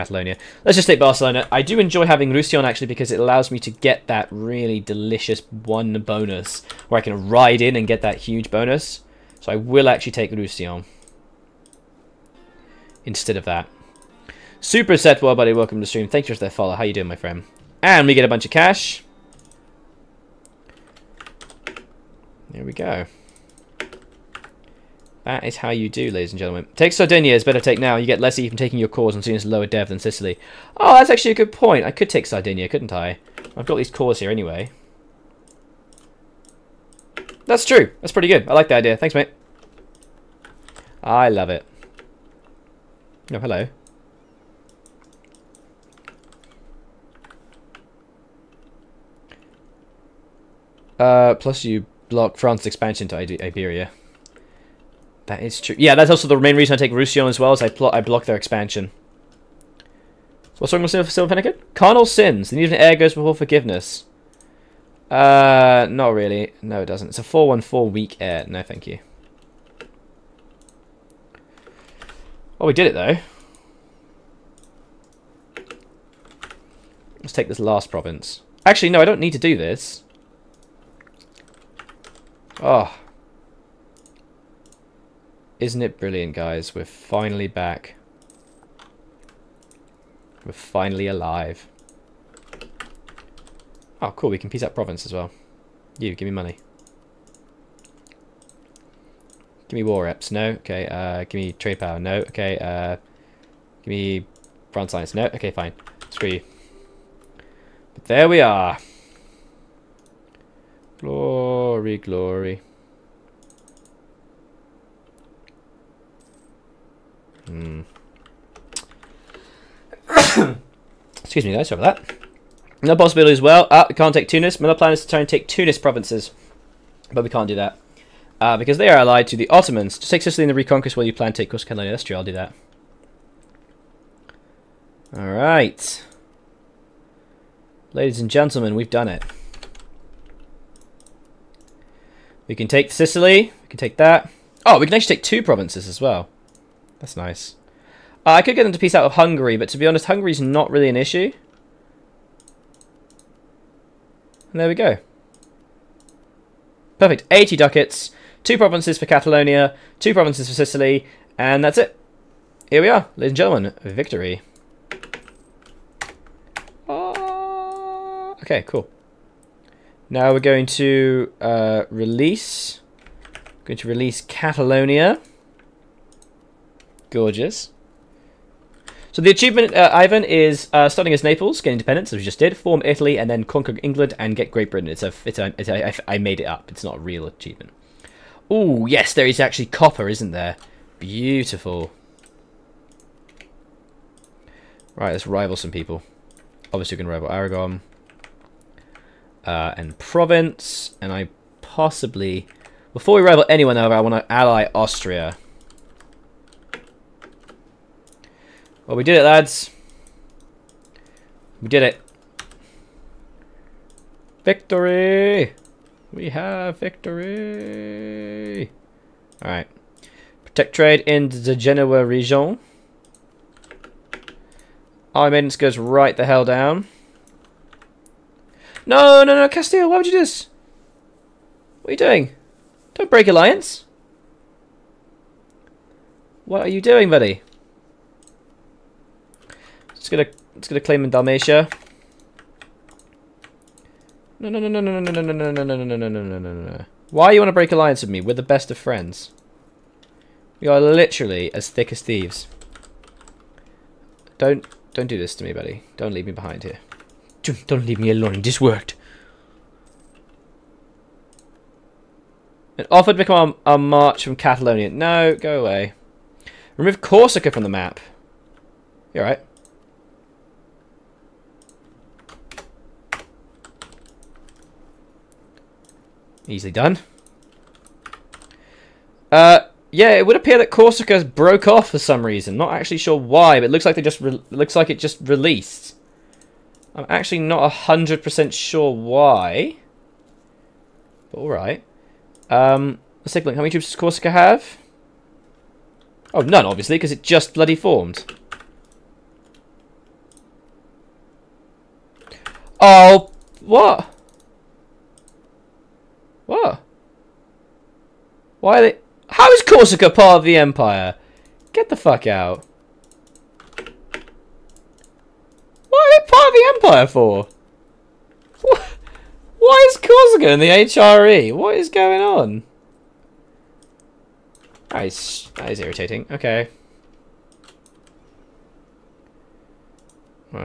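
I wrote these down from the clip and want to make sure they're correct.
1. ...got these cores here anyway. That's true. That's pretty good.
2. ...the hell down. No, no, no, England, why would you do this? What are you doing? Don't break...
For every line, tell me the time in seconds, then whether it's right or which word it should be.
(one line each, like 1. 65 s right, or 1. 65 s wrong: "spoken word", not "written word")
1. 33 s right
2. 226 s wrong: "Castile", not "England".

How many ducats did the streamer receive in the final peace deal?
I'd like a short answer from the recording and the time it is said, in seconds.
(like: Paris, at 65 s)
80, at 157 s.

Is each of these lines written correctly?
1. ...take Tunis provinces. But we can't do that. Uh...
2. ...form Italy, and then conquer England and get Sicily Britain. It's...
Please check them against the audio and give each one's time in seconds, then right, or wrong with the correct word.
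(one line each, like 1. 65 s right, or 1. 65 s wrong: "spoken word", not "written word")
1. 125 s right
2. 182 s wrong: "Great", not "Sicily".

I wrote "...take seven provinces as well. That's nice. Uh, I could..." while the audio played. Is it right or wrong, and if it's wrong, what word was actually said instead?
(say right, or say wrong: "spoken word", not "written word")
wrong: "two", not "seven".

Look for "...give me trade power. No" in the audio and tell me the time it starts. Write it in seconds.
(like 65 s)
101 s.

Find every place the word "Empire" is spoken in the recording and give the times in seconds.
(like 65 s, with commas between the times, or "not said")
310 s, 316 s.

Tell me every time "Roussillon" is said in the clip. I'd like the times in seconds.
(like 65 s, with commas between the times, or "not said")
2 s, 10 s, 56 s.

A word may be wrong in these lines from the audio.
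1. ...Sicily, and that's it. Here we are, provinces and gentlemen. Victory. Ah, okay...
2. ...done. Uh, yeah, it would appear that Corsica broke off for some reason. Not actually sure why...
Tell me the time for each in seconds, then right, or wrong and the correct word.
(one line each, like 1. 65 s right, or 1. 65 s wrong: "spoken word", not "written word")
1. 160 s wrong: "ladies", not "provinces"
2. 276 s right.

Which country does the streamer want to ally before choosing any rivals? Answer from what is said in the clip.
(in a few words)
Austria.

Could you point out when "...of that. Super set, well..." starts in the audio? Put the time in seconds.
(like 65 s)
13 s.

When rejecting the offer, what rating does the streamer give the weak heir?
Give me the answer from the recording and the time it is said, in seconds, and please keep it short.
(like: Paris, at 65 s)
414, at 67 s.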